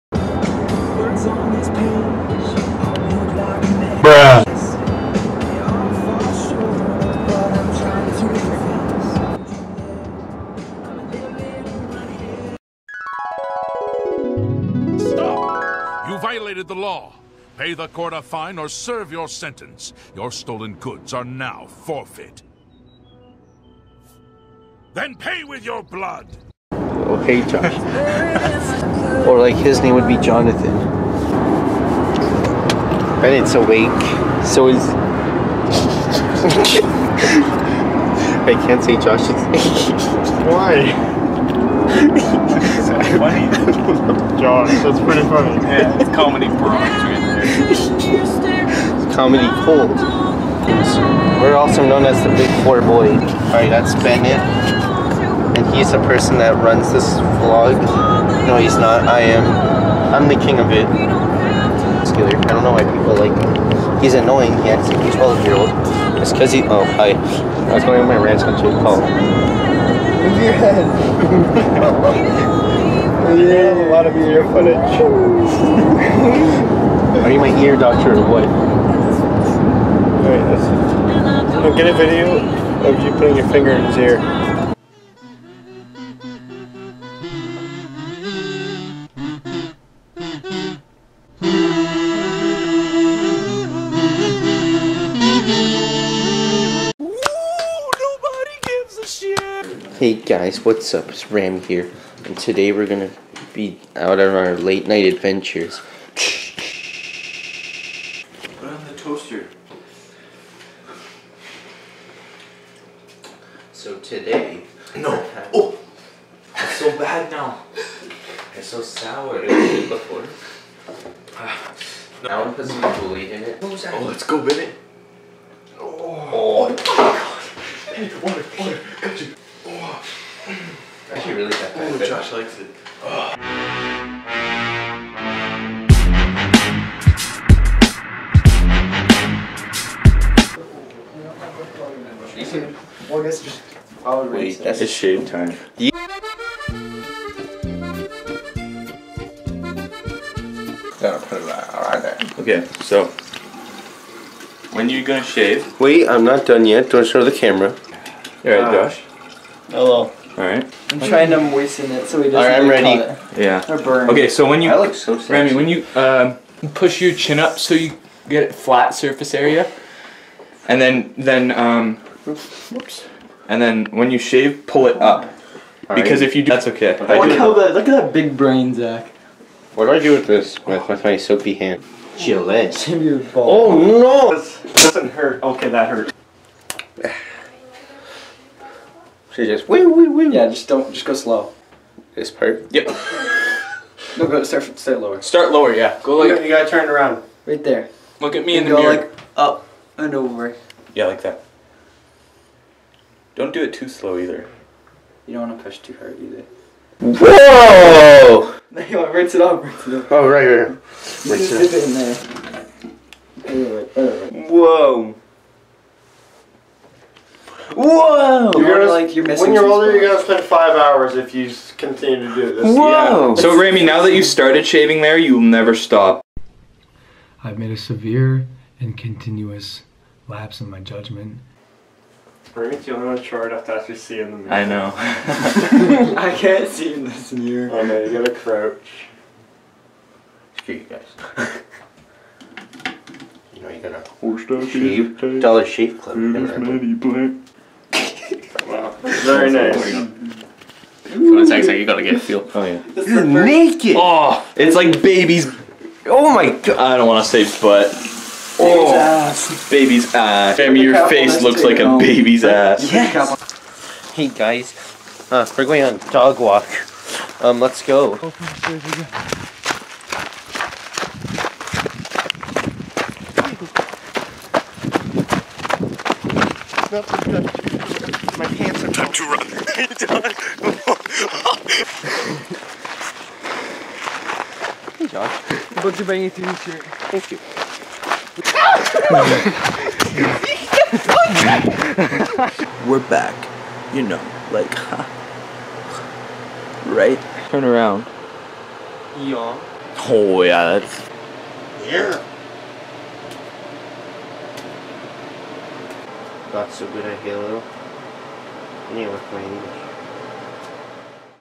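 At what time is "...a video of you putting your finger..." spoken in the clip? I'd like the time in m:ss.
1:21.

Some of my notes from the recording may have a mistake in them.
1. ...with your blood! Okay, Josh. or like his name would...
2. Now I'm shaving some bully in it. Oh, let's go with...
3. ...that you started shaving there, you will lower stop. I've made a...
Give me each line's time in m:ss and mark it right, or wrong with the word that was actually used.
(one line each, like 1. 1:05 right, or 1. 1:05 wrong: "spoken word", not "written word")
1. 0:25 right
2. 2:02 wrong: "putting", not "shaving"
3. 3:44 wrong: "never", not "lower".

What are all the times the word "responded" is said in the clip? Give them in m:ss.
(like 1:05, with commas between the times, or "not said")
not said.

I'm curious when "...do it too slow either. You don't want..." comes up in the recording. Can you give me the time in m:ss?
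3:23.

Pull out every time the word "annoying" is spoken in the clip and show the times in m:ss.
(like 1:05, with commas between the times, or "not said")
1:04.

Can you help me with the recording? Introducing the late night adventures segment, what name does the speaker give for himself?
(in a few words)
Ram.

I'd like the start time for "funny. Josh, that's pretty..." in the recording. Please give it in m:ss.
0:43.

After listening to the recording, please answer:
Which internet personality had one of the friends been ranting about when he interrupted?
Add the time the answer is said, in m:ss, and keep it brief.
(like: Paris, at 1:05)
Jake Paul, at 1:08.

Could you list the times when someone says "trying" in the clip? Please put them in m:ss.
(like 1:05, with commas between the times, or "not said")
2:41.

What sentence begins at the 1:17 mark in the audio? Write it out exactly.
Are you my ear doctor or what?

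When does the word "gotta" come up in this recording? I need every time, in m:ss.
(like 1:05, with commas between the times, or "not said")
3:16, 3:58, 4:03, 4:11.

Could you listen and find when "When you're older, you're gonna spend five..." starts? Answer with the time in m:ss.
3:39.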